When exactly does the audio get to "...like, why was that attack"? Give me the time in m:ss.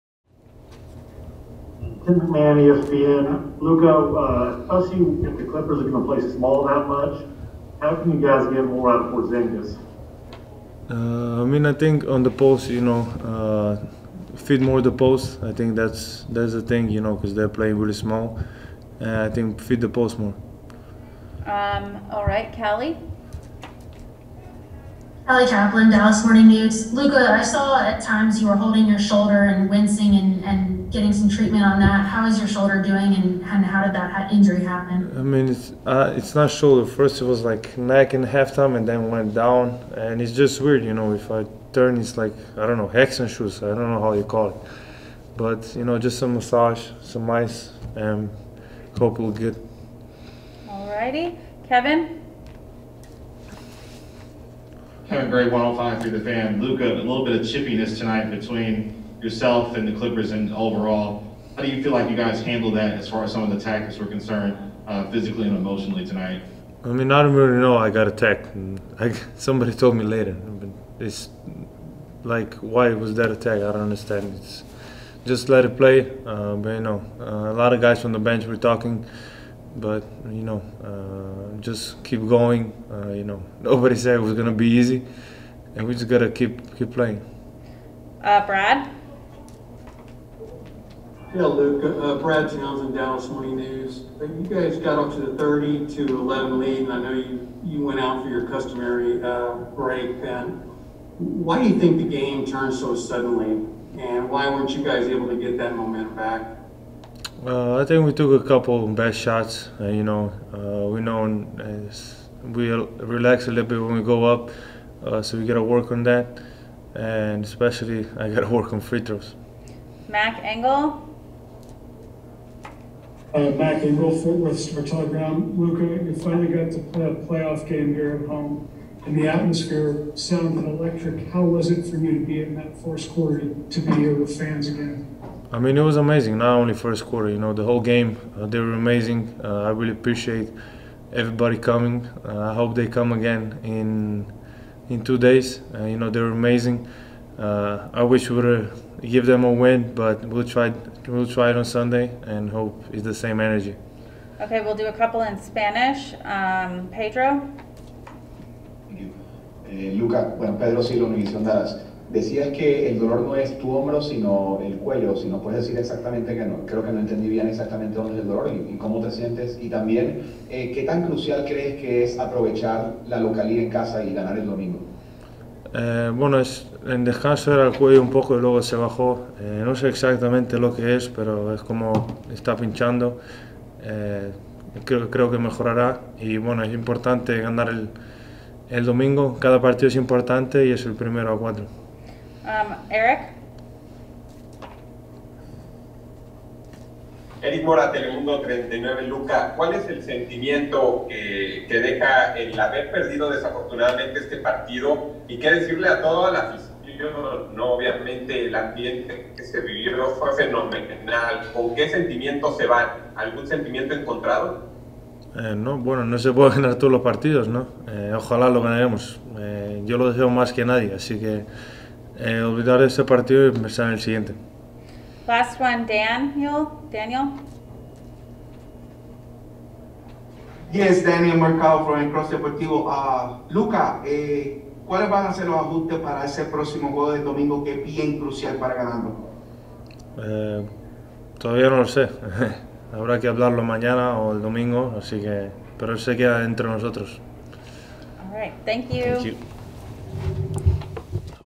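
1:12.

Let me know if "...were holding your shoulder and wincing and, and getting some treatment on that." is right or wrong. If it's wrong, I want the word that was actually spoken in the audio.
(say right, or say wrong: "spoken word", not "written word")
right.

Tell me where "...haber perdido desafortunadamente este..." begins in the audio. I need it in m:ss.
3:22.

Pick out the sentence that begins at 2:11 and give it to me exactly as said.
How was it for you to be in that fourth quarter to be here with fans again?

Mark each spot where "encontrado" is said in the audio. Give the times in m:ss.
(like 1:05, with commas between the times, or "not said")
3:33.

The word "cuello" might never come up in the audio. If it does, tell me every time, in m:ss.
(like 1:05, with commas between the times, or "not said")
2:44, 2:57.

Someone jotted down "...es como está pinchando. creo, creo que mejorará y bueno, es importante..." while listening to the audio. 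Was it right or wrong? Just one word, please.
right.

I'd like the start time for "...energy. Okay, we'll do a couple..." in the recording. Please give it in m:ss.
2:33.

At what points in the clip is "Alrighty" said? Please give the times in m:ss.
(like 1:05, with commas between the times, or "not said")
0:50.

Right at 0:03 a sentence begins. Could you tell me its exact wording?
Luka, uh, see if the Clippers are going to play small that much, how can you guys get more out of Porzingis?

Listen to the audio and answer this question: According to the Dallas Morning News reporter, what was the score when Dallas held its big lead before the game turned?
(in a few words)
30 to 11.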